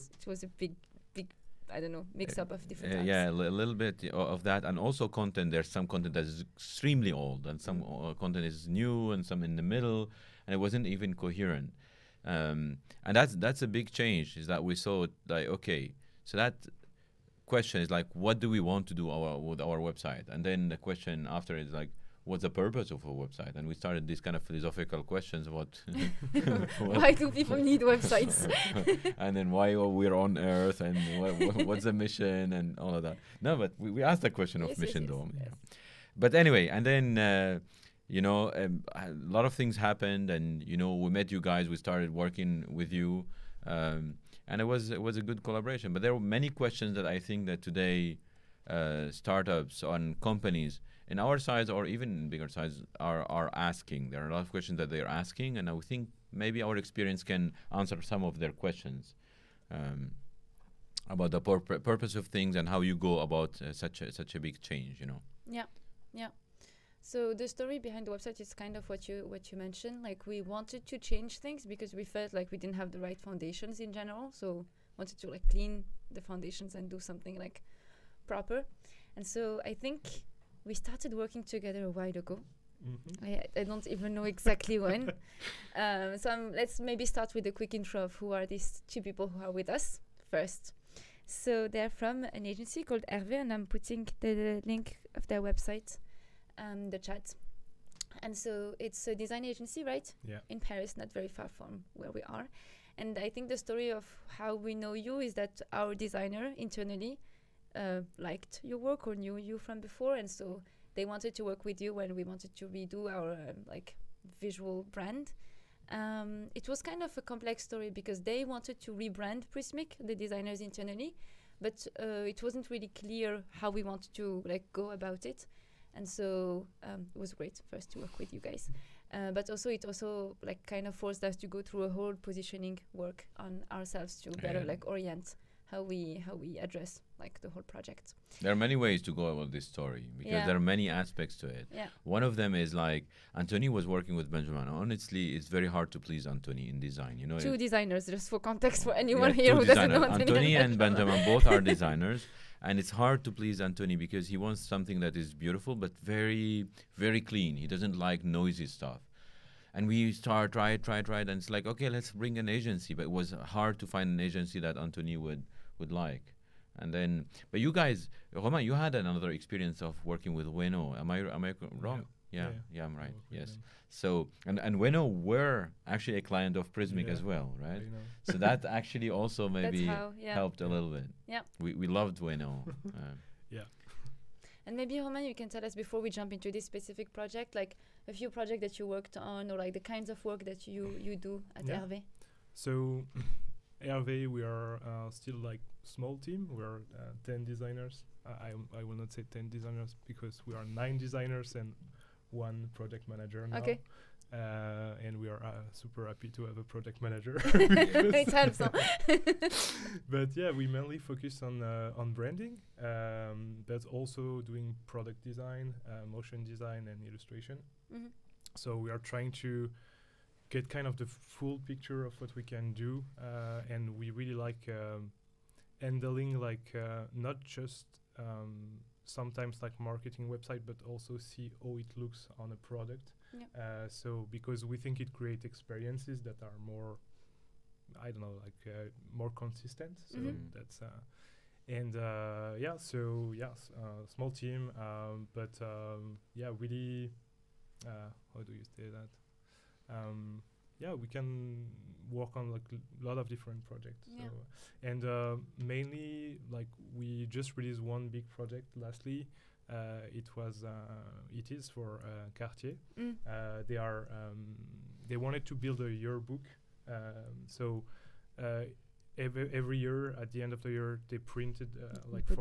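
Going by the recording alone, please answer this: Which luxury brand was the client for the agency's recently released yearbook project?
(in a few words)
Cartier.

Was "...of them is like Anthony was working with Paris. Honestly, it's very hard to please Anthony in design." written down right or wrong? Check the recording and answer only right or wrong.
wrong.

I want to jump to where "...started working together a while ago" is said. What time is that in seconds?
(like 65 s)
80 s.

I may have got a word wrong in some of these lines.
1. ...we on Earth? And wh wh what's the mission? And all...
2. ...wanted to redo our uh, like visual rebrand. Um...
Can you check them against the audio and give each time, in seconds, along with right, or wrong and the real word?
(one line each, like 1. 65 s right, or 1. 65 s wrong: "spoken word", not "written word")
1. 29 s right
2. 112 s wrong: "brand", not "rebrand".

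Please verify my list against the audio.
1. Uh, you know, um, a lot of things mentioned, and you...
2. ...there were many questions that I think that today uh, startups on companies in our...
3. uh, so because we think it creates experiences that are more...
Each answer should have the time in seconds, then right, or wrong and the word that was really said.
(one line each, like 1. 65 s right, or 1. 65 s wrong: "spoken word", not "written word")
1. 37 s wrong: "happened", not "mentioned"
2. 46 s right
3. 233 s right.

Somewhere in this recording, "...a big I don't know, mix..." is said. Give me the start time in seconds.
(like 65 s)
0 s.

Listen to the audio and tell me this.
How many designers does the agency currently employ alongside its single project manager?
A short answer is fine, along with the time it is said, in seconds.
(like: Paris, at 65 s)
9, at 200 s.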